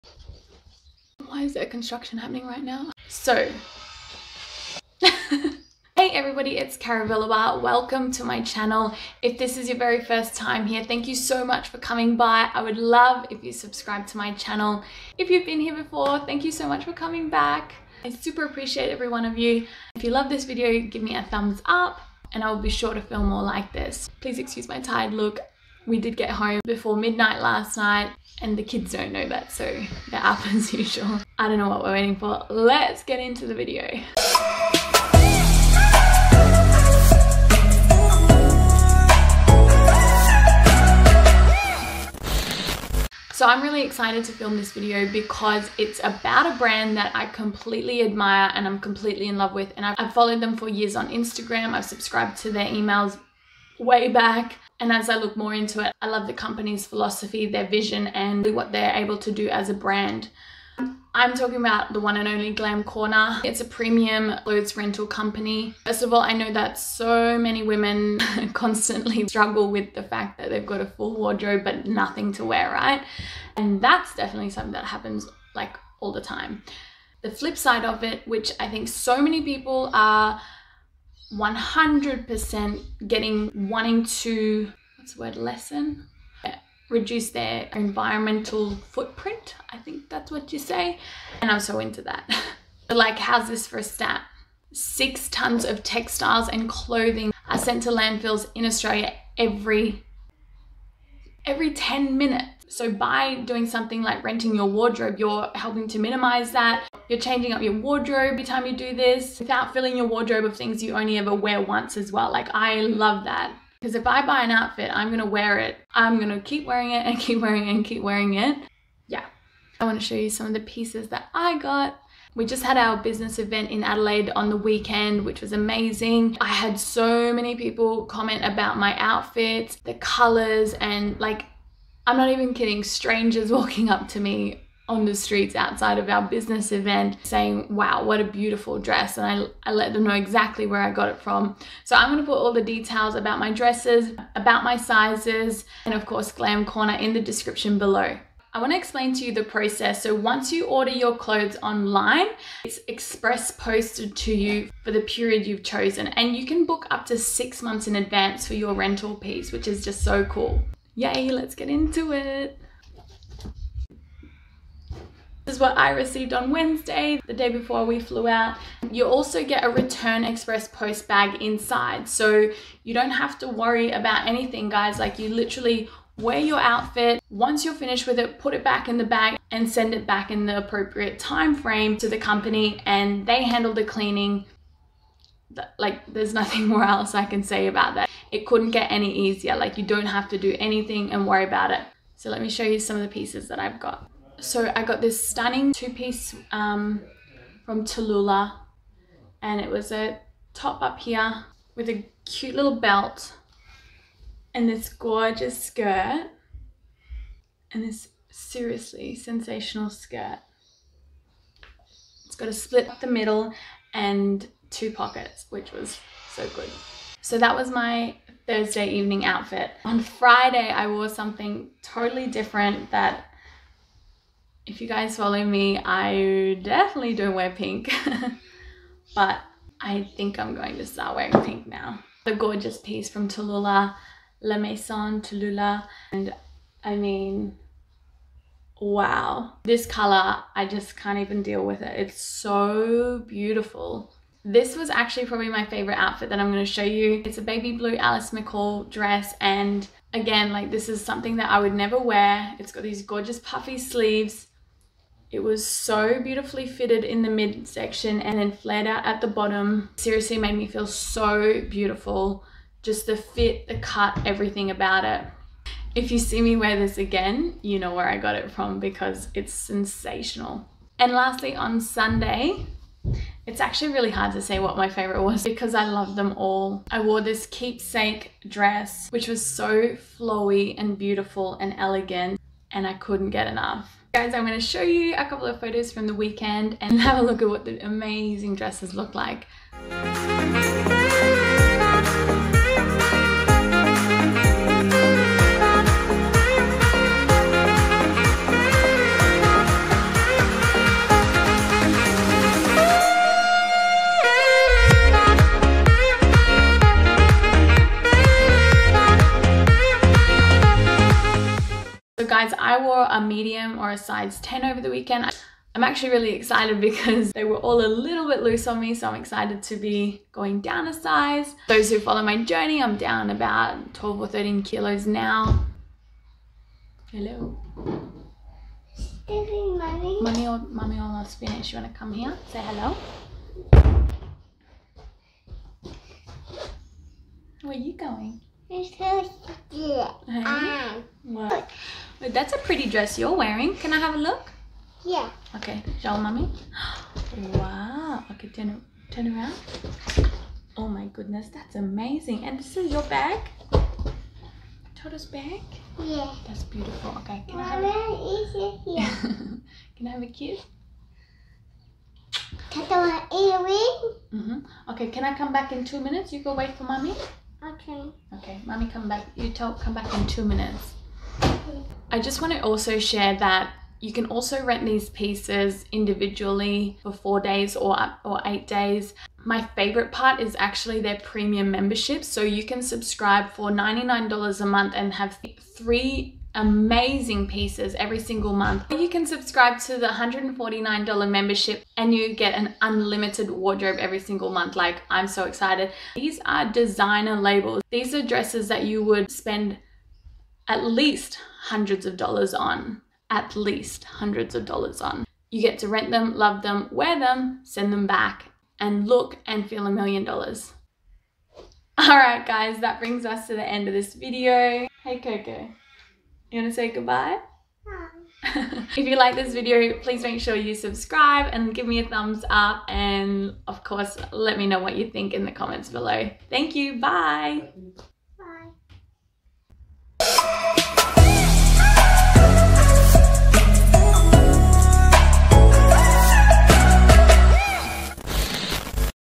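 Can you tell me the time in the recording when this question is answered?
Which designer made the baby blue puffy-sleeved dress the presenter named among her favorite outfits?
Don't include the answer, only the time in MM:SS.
04:07.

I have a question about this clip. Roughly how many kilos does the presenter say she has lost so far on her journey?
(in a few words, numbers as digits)
12 or 13 kilos.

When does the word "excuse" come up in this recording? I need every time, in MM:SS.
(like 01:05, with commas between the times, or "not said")
00:24.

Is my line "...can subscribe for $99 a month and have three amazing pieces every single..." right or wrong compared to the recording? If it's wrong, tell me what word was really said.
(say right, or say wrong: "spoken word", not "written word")
right.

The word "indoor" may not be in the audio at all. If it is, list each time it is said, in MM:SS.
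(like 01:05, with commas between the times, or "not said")
not said.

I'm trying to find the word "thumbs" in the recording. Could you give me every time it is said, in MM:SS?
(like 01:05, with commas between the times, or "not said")
00:21, 07:02.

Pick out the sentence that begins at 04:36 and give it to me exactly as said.
I wore this keepsake dress, which was so flowy and beautiful and elegant, and I couldn't get enough.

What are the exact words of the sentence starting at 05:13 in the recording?
a medium or a size 10 over the weekend.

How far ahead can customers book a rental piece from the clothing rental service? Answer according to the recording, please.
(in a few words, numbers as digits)
6 months.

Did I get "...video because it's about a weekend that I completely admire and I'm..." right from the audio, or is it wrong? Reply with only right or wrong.
wrong.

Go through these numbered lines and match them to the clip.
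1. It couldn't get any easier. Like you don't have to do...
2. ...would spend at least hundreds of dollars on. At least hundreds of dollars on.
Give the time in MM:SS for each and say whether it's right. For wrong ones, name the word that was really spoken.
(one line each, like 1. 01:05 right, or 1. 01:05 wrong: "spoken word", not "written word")
1. 03:08 right
2. 06:39 right.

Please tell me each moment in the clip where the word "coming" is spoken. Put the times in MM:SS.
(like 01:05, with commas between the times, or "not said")
00:11, 00:16.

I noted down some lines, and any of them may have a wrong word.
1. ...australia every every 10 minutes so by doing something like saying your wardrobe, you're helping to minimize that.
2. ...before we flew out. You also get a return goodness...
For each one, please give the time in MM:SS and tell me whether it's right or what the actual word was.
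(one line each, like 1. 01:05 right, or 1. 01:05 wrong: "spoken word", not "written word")
1. 01:38 wrong: "renting", not "saying"
2. 02:47 wrong: "express", not "goodness".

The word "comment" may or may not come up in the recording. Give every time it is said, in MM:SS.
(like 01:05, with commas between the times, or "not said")
02:08, 07:05.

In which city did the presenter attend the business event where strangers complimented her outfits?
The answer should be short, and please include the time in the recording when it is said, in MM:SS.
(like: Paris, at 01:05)
Adelaide, at 02:03.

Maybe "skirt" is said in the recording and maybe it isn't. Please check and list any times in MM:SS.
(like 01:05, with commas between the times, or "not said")
03:25, 03:29.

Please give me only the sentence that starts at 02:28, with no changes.
I want to explain to you the process.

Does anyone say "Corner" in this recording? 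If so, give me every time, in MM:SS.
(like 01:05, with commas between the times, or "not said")
01:02, 02:26.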